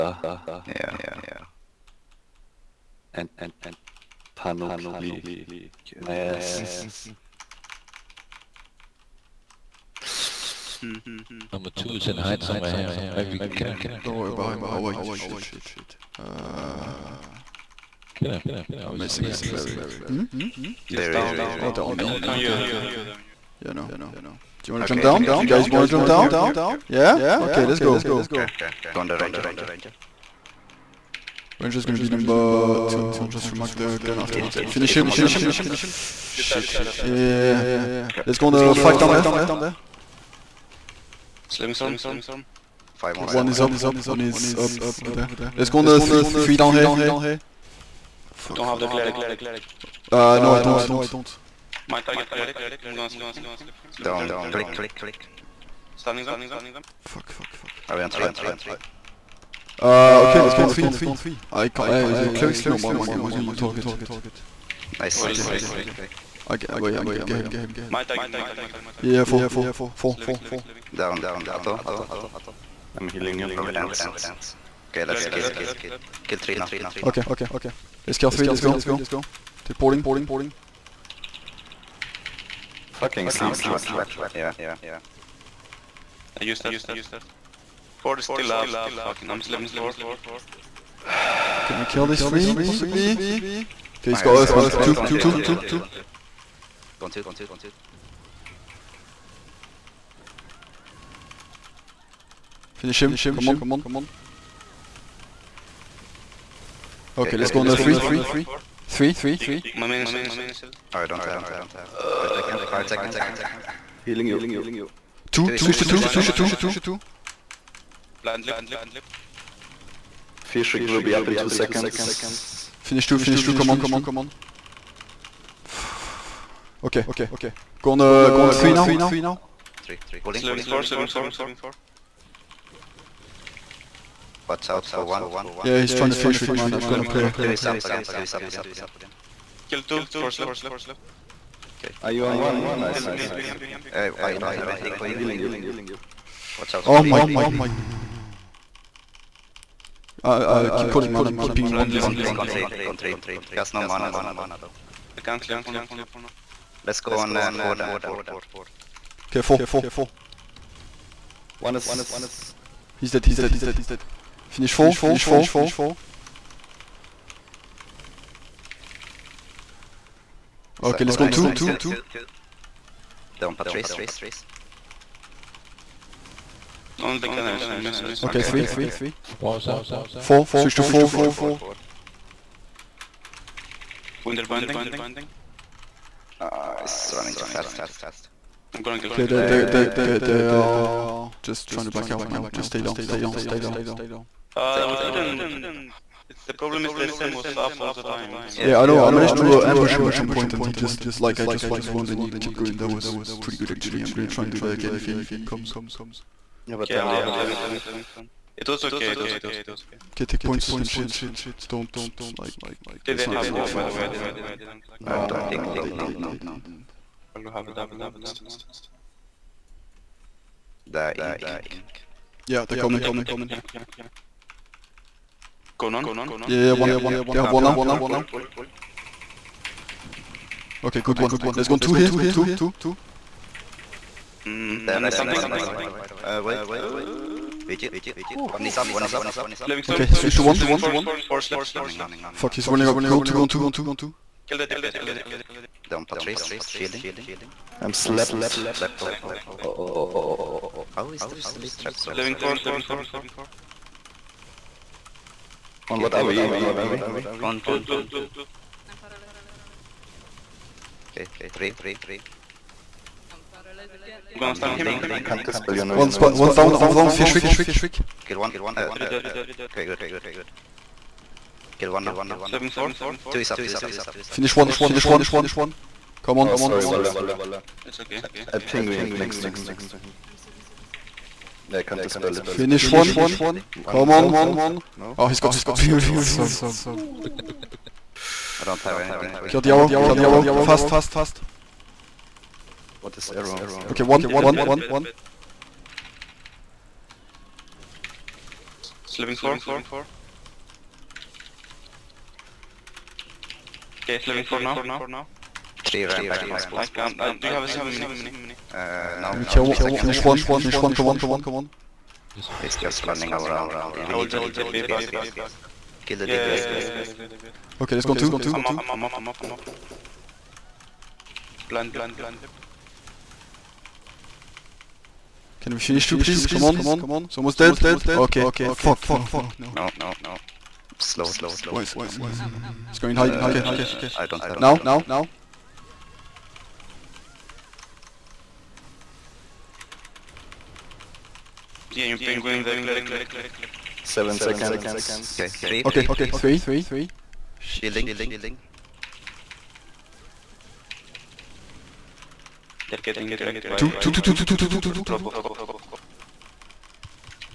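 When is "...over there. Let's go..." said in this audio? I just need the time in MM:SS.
00:45.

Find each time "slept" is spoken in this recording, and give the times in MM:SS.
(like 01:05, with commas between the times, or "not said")
04:07.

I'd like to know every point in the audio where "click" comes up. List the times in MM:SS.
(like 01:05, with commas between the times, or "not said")
00:54, 05:43.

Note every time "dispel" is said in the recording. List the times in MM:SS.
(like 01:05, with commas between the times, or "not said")
04:25, 04:42.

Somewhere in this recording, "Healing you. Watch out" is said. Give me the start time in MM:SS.
02:25.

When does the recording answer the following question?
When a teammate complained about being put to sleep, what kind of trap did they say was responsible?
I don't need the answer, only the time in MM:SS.
01:23.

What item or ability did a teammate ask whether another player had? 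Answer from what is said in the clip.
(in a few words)
silver mini.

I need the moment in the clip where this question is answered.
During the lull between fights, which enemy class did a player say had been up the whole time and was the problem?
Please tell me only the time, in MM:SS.
03:17.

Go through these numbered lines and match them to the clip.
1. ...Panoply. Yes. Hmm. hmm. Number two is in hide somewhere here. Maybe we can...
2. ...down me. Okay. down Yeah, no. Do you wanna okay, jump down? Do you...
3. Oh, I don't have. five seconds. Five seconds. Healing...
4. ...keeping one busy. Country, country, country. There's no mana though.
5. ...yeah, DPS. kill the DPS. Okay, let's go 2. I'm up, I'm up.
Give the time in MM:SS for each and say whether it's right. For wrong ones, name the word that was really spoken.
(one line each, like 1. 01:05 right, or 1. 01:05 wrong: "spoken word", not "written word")
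1. 00:04 right
2. 00:21 right
3. 01:50 right
4. 02:31 right
5. 05:16 right.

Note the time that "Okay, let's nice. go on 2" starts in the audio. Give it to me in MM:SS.
02:50.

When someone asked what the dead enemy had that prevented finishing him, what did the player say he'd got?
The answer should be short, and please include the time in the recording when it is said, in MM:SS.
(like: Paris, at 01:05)
spirits, at 04:45.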